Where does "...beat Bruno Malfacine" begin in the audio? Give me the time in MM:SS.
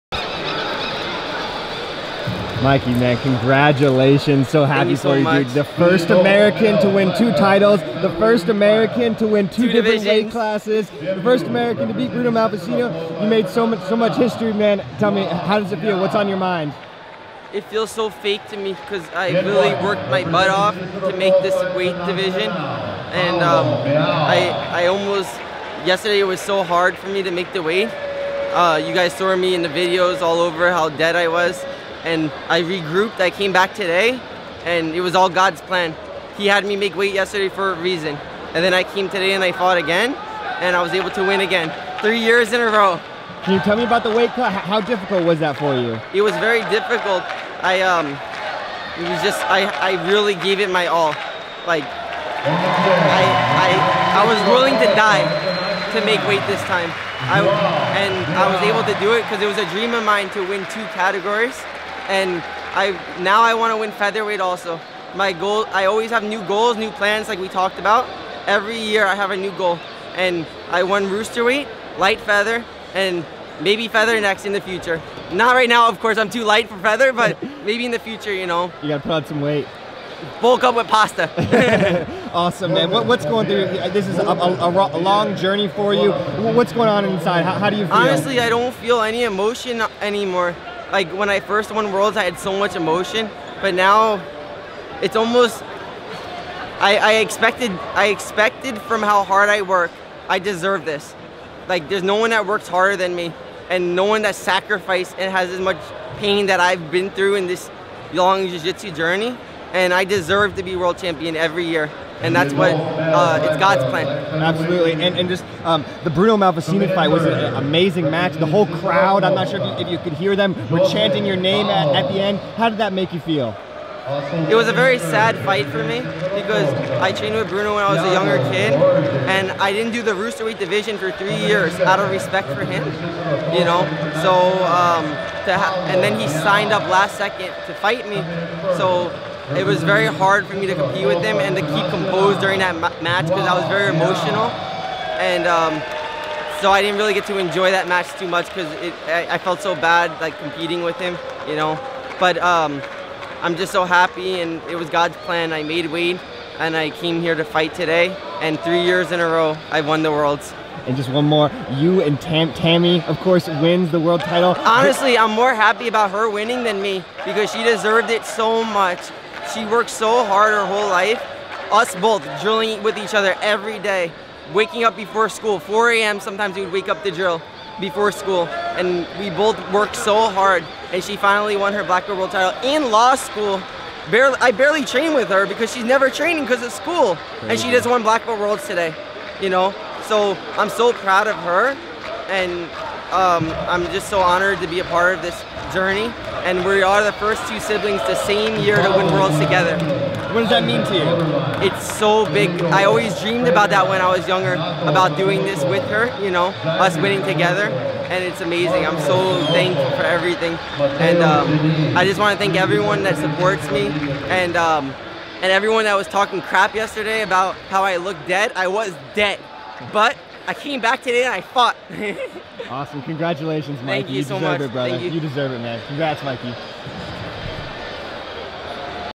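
00:11.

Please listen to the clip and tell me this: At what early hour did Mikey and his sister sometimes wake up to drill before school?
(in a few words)
4 a.m.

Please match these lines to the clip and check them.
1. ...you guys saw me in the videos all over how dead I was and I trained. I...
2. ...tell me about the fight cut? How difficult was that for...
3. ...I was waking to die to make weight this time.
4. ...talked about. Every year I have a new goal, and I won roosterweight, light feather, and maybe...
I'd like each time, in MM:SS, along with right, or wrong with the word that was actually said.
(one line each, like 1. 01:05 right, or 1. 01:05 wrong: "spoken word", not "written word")
1. 00:28 wrong: "regrouped", not "trained"
2. 00:43 wrong: "weight", not "fight"
3. 00:54 wrong: "willing", not "waking"
4. 01:07 right.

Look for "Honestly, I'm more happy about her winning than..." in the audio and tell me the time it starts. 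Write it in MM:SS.
02:44.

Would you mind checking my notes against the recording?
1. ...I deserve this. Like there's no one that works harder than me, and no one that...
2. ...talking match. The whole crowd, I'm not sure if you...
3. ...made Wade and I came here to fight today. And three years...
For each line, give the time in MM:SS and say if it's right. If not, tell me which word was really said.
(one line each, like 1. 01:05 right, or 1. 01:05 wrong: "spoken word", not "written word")
1. 01:40 right
2. 01:57 wrong: "amazing", not "talking"
3. 02:35 right.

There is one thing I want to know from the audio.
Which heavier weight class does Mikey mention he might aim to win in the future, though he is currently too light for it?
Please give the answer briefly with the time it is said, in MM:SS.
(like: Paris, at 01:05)
Featherweight, at 01:03.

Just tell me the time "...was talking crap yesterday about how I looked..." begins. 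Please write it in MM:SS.
03:35.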